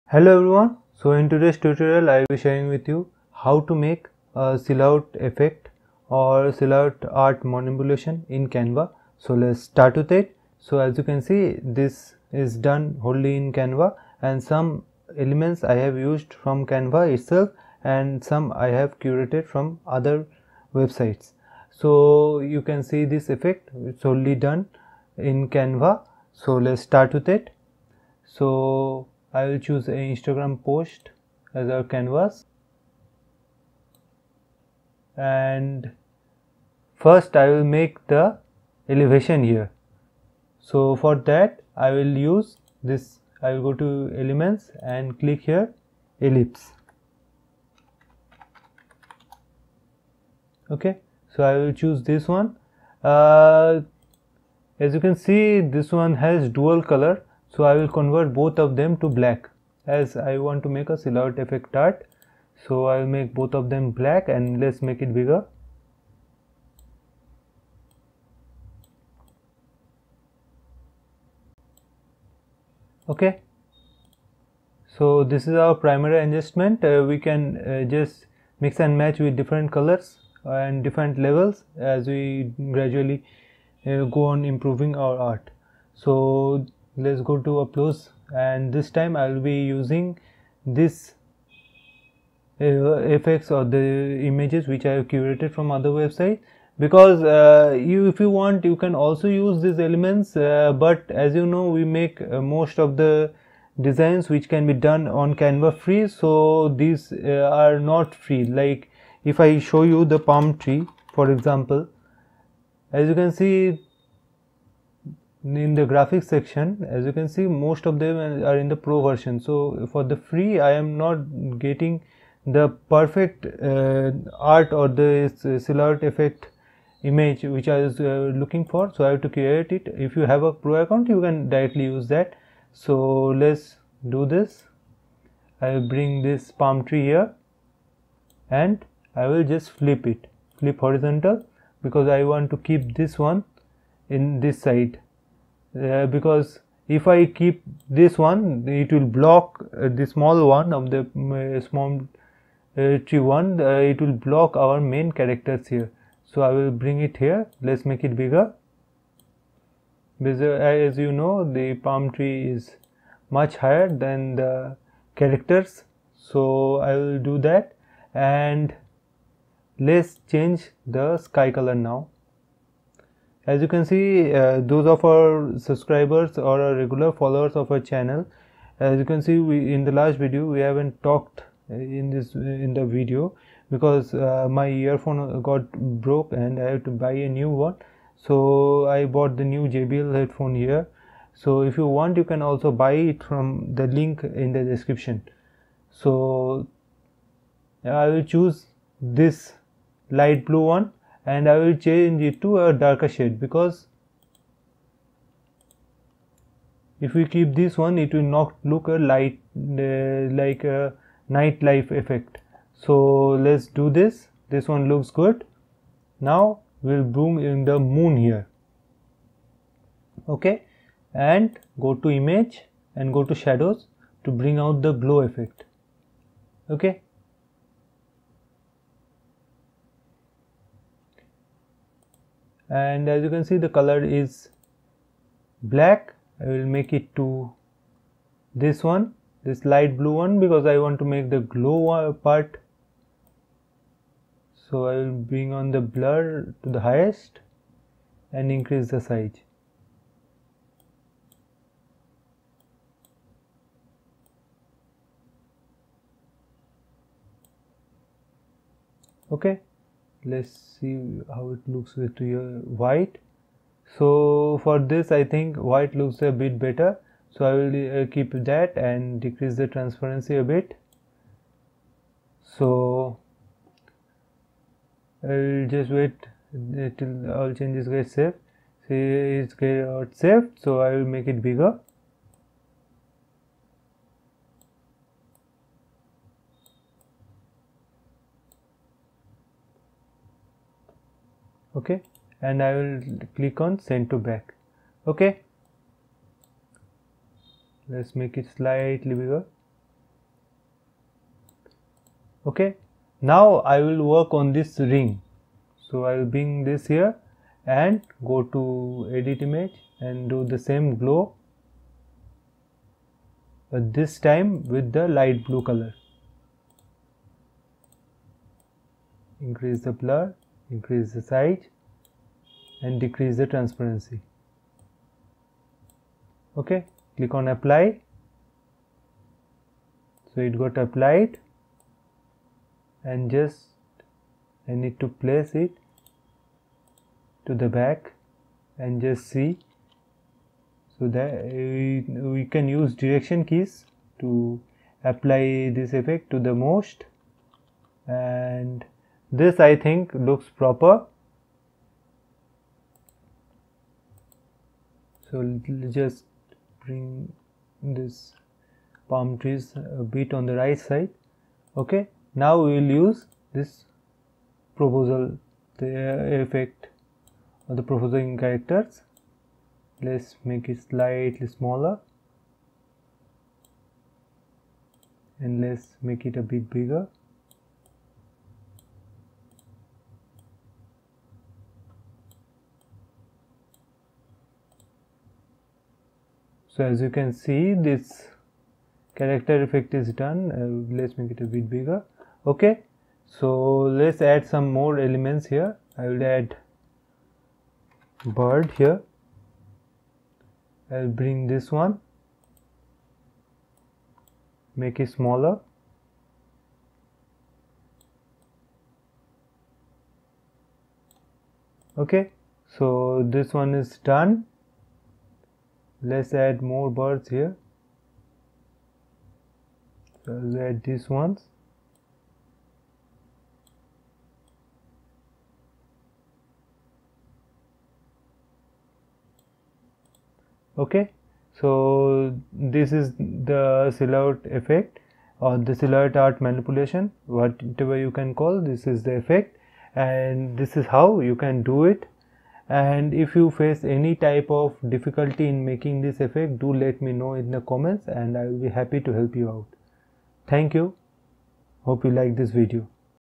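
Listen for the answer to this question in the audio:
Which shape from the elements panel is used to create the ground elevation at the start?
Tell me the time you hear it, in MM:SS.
00:46.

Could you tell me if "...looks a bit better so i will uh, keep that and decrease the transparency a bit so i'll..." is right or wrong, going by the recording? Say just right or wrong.
right.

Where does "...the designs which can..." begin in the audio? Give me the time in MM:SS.
01:42.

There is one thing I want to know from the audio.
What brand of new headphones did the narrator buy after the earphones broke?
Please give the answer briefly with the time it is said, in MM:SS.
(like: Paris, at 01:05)
JBL, at 03:09.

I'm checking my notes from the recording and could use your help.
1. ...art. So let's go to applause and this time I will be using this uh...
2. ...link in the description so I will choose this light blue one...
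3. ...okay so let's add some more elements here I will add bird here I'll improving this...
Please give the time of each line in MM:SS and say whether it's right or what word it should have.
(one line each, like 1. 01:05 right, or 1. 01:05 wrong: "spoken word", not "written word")
1. 01:25 right
2. 03:13 right
3. 06:32 wrong: "bring", not "improving".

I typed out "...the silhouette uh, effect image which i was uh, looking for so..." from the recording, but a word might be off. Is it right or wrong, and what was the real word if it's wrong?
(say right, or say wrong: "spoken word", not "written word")
right.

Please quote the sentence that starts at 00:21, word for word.
So you can see this effect it's only done in Canva.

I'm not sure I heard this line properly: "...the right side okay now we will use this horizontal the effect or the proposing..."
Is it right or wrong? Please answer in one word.
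wrong.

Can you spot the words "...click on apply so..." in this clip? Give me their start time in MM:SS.
05:27.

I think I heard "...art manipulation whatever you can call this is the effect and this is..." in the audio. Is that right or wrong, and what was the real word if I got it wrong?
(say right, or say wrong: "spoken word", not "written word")
right.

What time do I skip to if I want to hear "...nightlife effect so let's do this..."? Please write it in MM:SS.
03:31.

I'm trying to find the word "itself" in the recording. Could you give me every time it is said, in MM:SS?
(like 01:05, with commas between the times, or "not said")
00:17.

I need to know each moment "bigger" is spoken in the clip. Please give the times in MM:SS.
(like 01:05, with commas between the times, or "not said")
01:05, 02:38, 04:41, 04:59, 06:16, 06:31.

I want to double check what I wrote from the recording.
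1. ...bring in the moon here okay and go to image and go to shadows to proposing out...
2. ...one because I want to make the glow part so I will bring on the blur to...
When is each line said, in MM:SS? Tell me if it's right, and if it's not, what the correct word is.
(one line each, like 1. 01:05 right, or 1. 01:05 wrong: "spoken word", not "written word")
1. 03:37 wrong: "bring", not "proposing"
2. 04:00 right.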